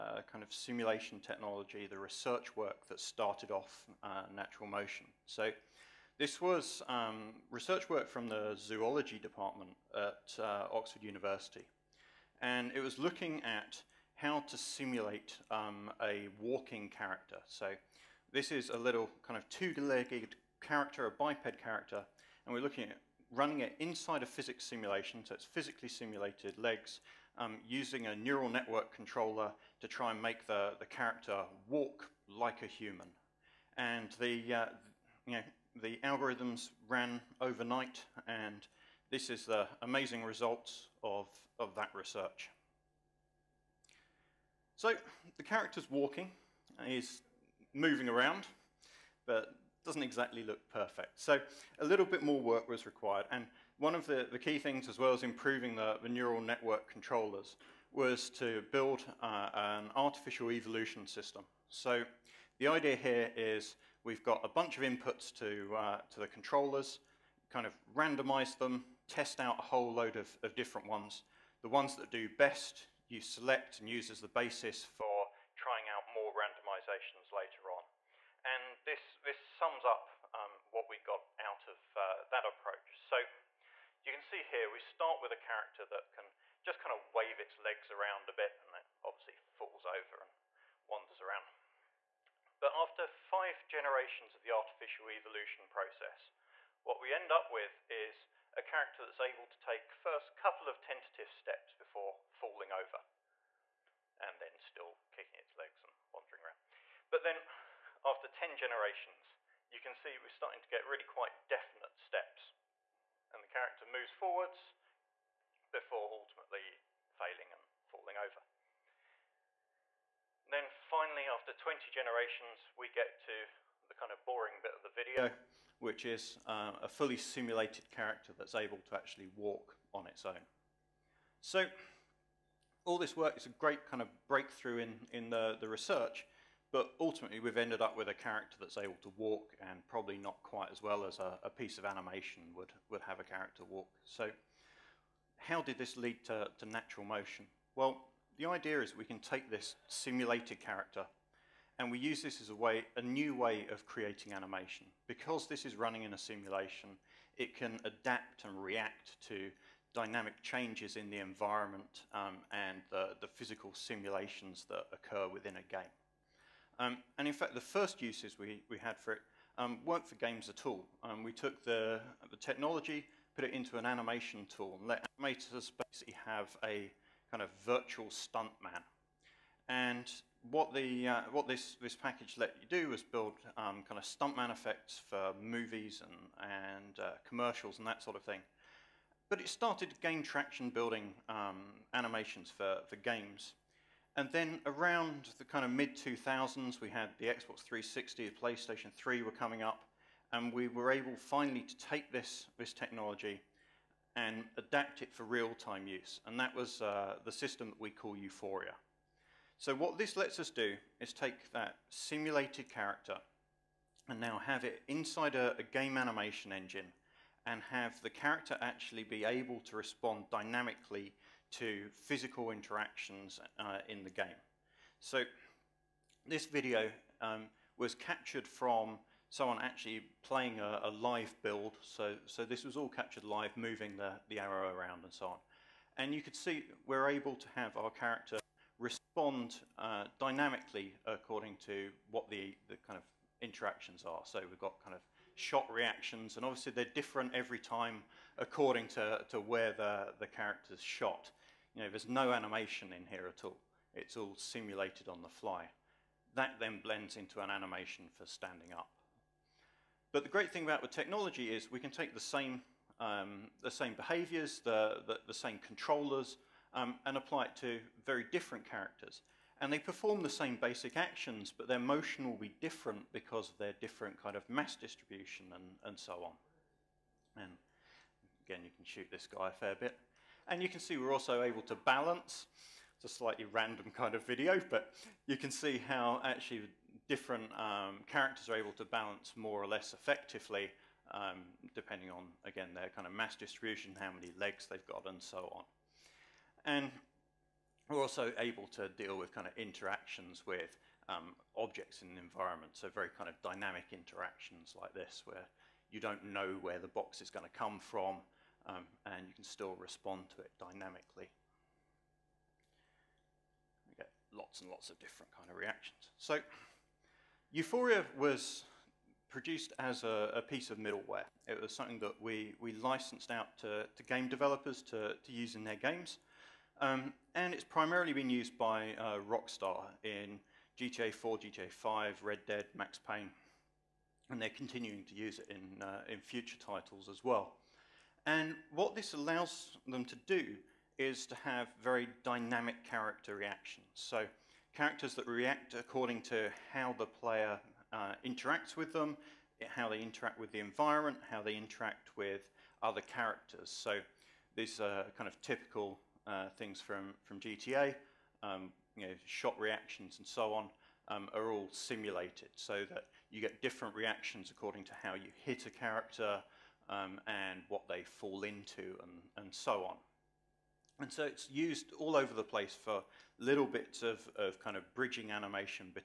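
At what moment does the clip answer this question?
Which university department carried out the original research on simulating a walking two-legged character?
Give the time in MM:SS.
00:08.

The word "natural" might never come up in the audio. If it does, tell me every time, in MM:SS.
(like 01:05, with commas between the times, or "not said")
00:04, 02:26.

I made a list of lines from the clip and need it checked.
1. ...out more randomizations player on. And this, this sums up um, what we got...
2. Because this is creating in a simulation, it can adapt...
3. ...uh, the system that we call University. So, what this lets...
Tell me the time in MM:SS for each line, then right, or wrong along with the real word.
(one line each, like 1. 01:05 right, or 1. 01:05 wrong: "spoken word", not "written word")
1. 01:15 wrong: "later", not "player"
2. 02:35 wrong: "running", not "creating"
3. 03:26 wrong: "Euphoria", not "University".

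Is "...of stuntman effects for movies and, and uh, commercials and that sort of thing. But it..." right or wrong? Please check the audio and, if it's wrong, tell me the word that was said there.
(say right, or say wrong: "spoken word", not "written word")
right.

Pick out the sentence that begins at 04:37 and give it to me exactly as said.
And again, you can shoot this guy a fair bit.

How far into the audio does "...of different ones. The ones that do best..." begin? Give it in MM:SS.
01:10.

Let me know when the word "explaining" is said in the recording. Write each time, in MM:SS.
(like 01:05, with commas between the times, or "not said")
not said.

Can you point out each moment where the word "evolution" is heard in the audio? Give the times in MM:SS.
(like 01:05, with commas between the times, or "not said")
01:00, 01:35.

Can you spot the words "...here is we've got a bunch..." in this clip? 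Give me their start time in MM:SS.
01:02.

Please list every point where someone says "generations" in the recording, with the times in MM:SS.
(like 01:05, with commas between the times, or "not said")
01:33, 01:48, 02:01.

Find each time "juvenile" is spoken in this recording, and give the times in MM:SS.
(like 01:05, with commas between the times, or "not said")
not said.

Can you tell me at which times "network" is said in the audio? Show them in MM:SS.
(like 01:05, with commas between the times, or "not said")
00:28, 00:56.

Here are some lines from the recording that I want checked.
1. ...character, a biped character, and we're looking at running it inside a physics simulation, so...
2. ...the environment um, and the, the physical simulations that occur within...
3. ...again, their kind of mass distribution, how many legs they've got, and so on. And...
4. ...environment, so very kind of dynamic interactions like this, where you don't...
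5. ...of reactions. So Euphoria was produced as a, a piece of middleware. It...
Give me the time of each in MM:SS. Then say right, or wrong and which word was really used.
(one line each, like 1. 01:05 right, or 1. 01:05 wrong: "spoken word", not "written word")
1. 00:20 right
2. 02:41 right
3. 04:52 right
4. 05:02 right
5. 05:15 right.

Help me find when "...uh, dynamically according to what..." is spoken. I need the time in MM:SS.
03:59.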